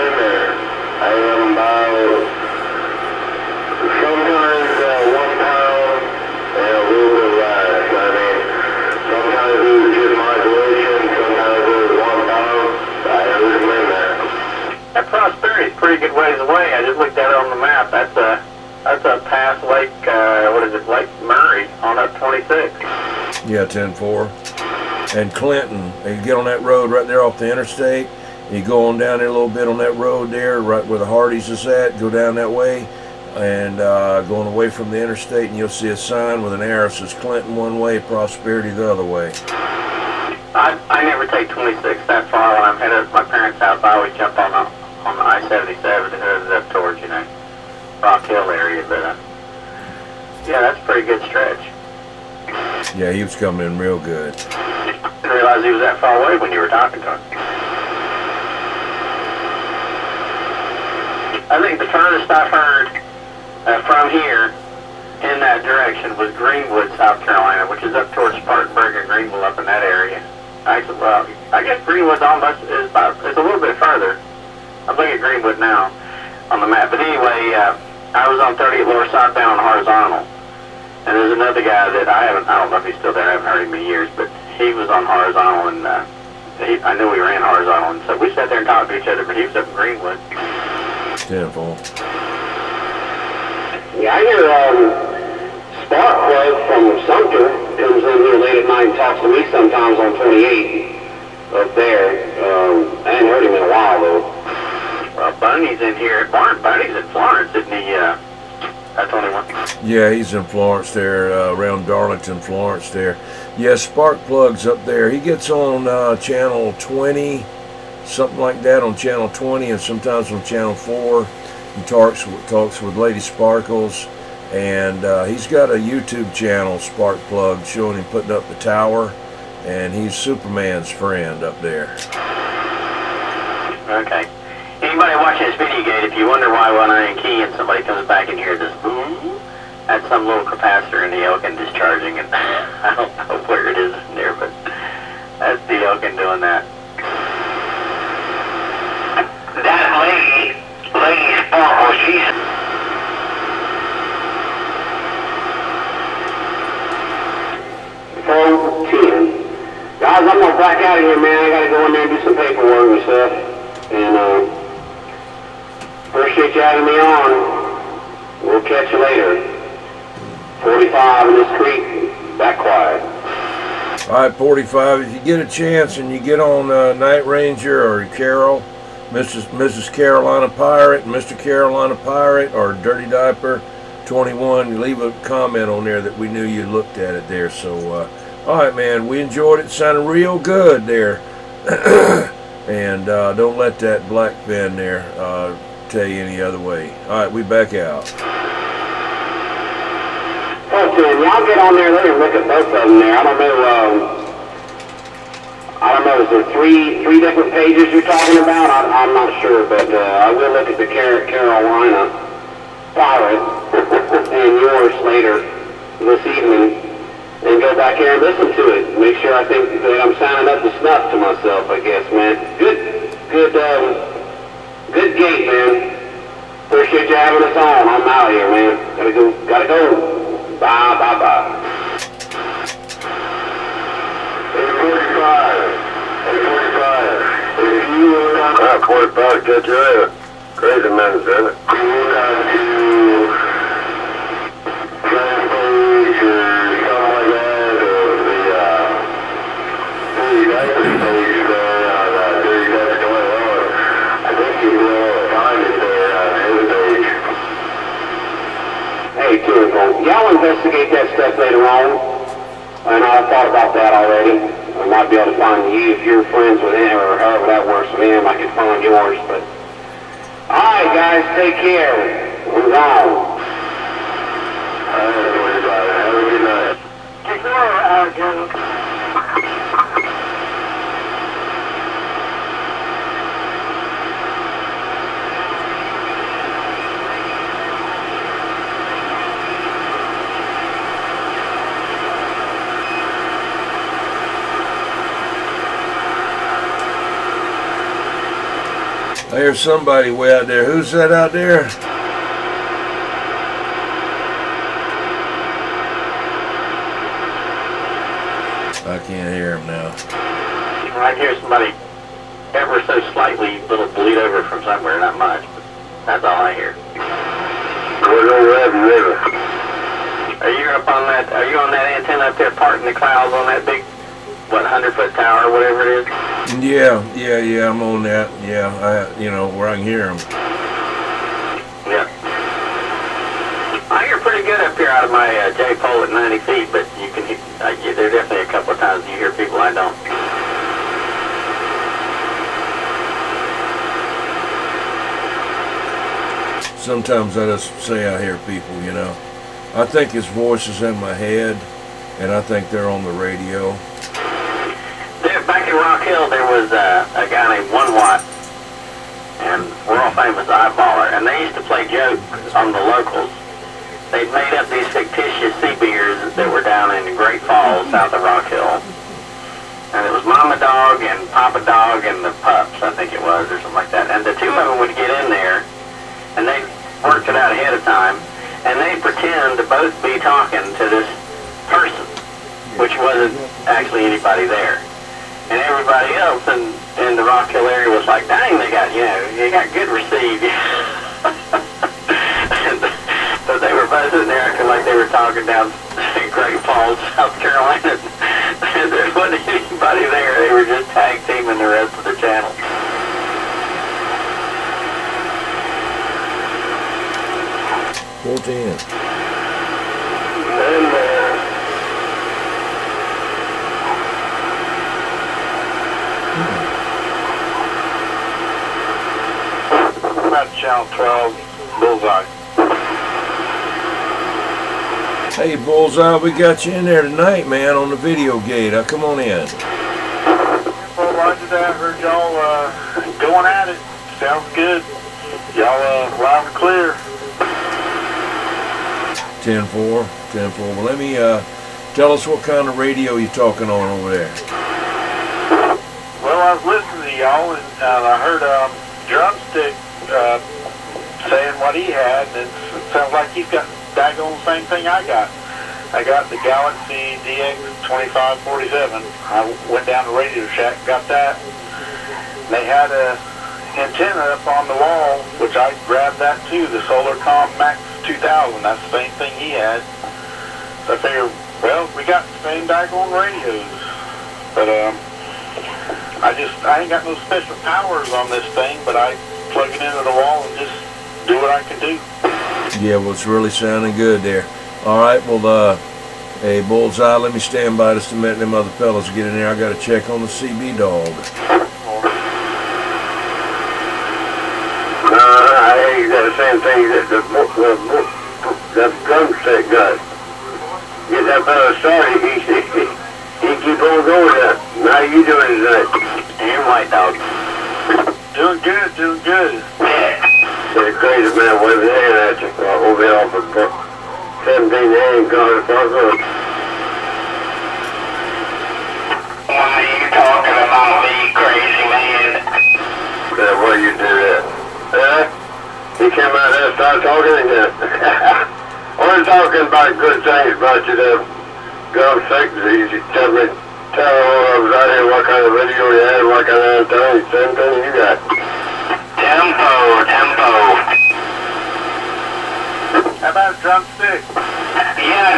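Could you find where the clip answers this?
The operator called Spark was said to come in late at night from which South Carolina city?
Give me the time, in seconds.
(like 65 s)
97 s.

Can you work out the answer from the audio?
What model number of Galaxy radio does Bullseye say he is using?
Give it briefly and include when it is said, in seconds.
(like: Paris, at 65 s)
DX2547, at 457 s.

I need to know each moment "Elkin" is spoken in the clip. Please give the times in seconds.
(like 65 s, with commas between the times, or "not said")
141 s, 145 s.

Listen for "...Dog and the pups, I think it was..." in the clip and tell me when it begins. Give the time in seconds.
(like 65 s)
371 s.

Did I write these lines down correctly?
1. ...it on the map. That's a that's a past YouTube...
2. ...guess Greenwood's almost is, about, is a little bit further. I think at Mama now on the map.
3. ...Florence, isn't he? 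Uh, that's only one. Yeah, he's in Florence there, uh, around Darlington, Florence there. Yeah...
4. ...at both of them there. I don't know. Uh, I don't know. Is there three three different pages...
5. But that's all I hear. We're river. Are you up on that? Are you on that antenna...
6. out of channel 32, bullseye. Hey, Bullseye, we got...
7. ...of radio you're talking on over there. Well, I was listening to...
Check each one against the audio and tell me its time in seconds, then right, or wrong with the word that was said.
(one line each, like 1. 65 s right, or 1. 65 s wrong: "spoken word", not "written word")
1. 17 s wrong: "Lake", not "YouTube"
2. 71 s wrong: "Greenwood", not "Mama"
3. 107 s right
4. 202 s right
5. 315 s right
6. 420 s wrong: "12", not "32"
7. 442 s right.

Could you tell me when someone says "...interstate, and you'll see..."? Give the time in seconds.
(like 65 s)
35 s.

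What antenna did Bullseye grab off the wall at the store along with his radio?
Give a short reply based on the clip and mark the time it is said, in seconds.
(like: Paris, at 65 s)
Solarcon Max 2000, at 466 s.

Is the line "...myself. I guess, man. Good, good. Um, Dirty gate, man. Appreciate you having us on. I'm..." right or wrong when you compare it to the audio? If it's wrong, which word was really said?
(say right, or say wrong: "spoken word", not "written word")
wrong: "Good", not "Dirty".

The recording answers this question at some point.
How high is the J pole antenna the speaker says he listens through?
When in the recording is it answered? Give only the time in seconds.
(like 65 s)
336 s.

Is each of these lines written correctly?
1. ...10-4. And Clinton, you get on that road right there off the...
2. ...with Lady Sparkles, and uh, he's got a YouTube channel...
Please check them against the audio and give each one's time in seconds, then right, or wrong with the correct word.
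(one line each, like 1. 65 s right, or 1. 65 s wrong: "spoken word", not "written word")
1. 23 s right
2. 122 s right.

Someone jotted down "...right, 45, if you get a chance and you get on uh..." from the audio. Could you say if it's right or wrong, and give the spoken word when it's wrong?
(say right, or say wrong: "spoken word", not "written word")
right.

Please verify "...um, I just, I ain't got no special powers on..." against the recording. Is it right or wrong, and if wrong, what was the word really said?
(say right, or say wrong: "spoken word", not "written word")
right.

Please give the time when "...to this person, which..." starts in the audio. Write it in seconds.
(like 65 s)
380 s.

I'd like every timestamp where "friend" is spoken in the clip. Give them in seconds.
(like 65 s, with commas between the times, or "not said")
130 s, 266 s.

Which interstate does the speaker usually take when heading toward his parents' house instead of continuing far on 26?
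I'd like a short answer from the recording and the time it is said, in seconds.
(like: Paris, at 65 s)
I-77, at 45 s.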